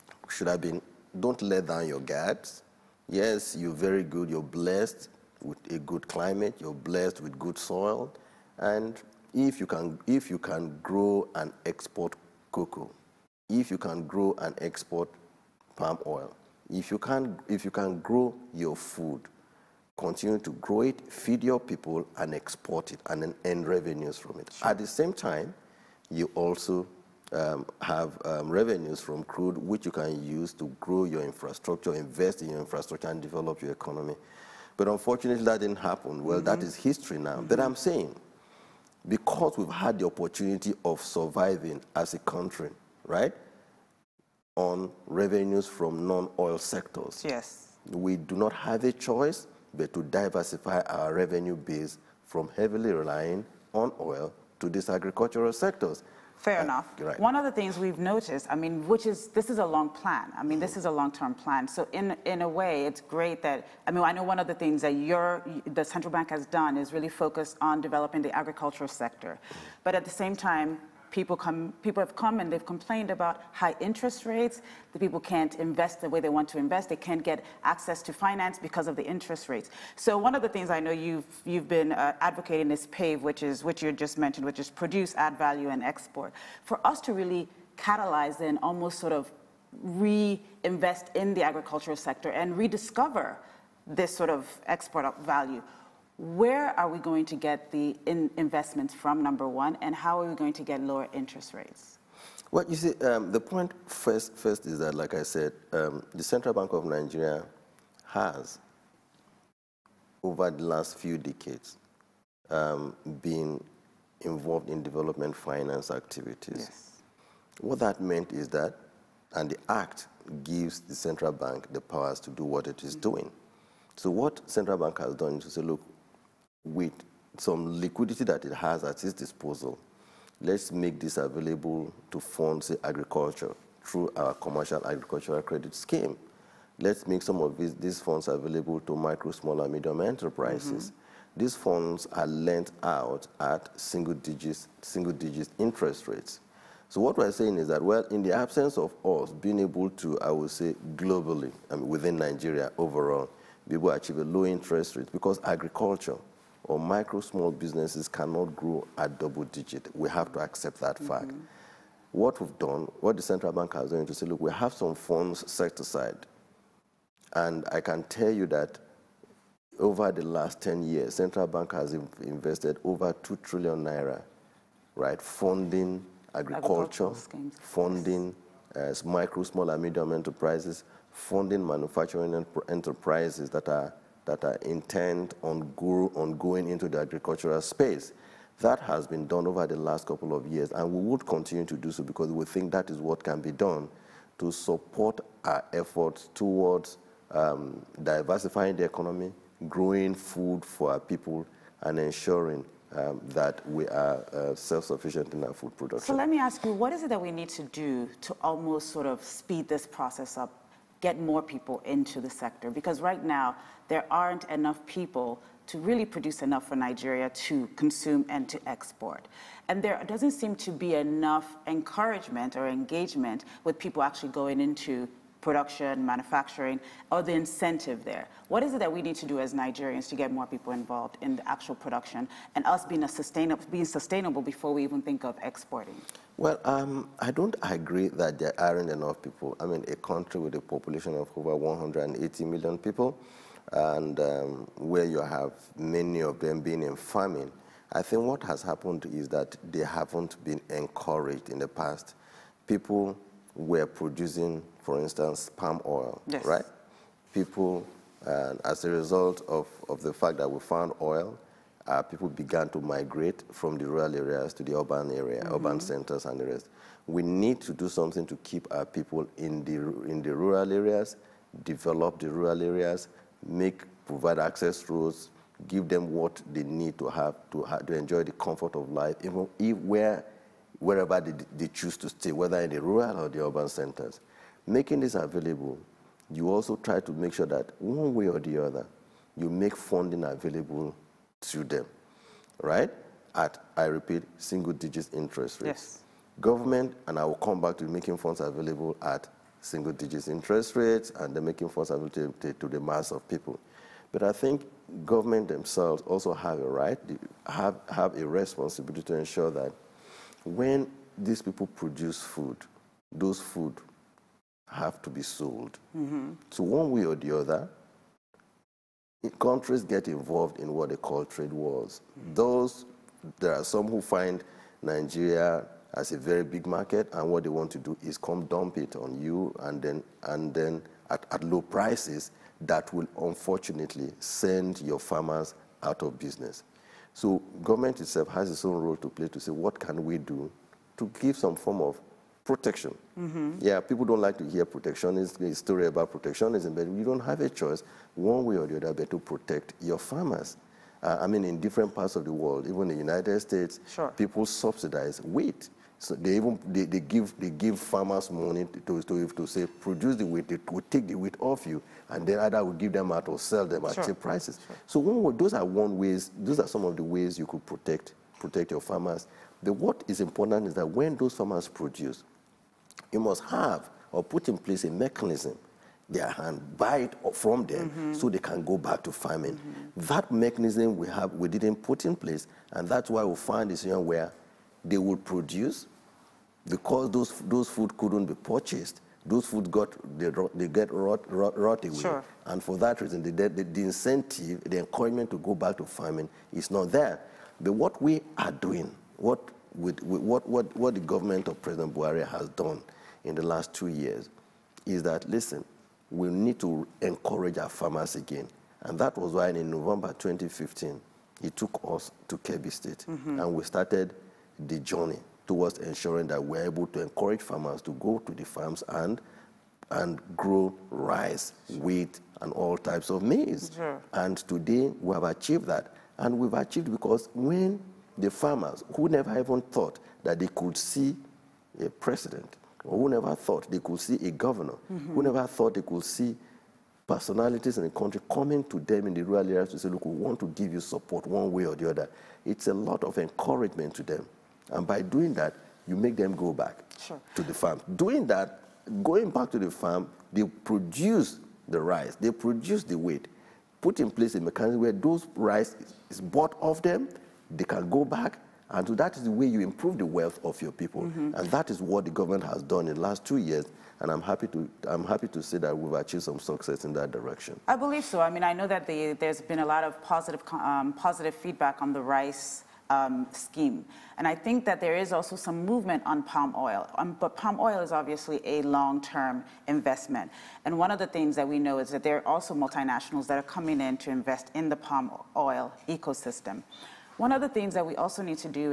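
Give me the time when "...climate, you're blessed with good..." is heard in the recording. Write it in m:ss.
0:06.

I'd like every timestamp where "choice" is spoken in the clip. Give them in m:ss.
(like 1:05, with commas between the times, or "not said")
0:49, 5:47.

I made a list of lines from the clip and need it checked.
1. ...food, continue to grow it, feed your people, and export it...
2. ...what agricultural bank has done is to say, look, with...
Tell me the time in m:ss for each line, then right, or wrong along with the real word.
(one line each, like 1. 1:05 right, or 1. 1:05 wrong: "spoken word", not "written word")
1. 0:18 right
2. 2:04 wrong: "central", not "agricultural".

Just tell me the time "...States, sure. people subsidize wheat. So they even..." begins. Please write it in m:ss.
5:53.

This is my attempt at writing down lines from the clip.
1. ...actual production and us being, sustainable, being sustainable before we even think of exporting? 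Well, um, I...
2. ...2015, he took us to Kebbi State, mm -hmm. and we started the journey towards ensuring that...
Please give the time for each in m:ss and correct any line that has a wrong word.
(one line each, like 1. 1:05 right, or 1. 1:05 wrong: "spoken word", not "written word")
1. 3:51 right
2. 6:50 right.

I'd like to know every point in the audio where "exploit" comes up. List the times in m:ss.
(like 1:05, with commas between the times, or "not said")
not said.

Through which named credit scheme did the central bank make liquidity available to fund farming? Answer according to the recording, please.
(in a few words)
Commercial agricultural credit scheme.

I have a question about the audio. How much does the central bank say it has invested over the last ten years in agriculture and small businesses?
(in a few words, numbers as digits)
Over 2 trillion naira.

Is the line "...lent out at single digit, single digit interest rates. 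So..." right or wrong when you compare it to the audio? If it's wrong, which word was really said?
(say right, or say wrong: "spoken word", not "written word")
right.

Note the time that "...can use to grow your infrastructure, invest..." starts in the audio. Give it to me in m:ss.
0:29.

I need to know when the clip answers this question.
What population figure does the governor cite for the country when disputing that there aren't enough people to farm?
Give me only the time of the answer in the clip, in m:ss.
4:01.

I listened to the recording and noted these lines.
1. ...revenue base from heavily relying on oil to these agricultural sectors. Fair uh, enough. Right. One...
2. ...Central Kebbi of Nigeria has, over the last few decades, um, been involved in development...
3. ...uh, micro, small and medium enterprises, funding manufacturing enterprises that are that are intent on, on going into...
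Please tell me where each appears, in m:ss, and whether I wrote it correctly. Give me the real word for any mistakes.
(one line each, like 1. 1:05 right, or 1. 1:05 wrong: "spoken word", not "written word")
1. 0:51 right
2. 1:46 wrong: "Bank", not "Kebbi"
3. 2:58 right.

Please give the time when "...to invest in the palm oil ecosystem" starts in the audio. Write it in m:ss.
8:03.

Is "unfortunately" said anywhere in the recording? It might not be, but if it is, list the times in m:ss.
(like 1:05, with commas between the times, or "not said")
0:34, 5:33.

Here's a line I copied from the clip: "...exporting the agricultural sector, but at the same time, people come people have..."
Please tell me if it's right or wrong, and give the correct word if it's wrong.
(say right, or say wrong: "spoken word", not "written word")
wrong: "developing", not "exporting".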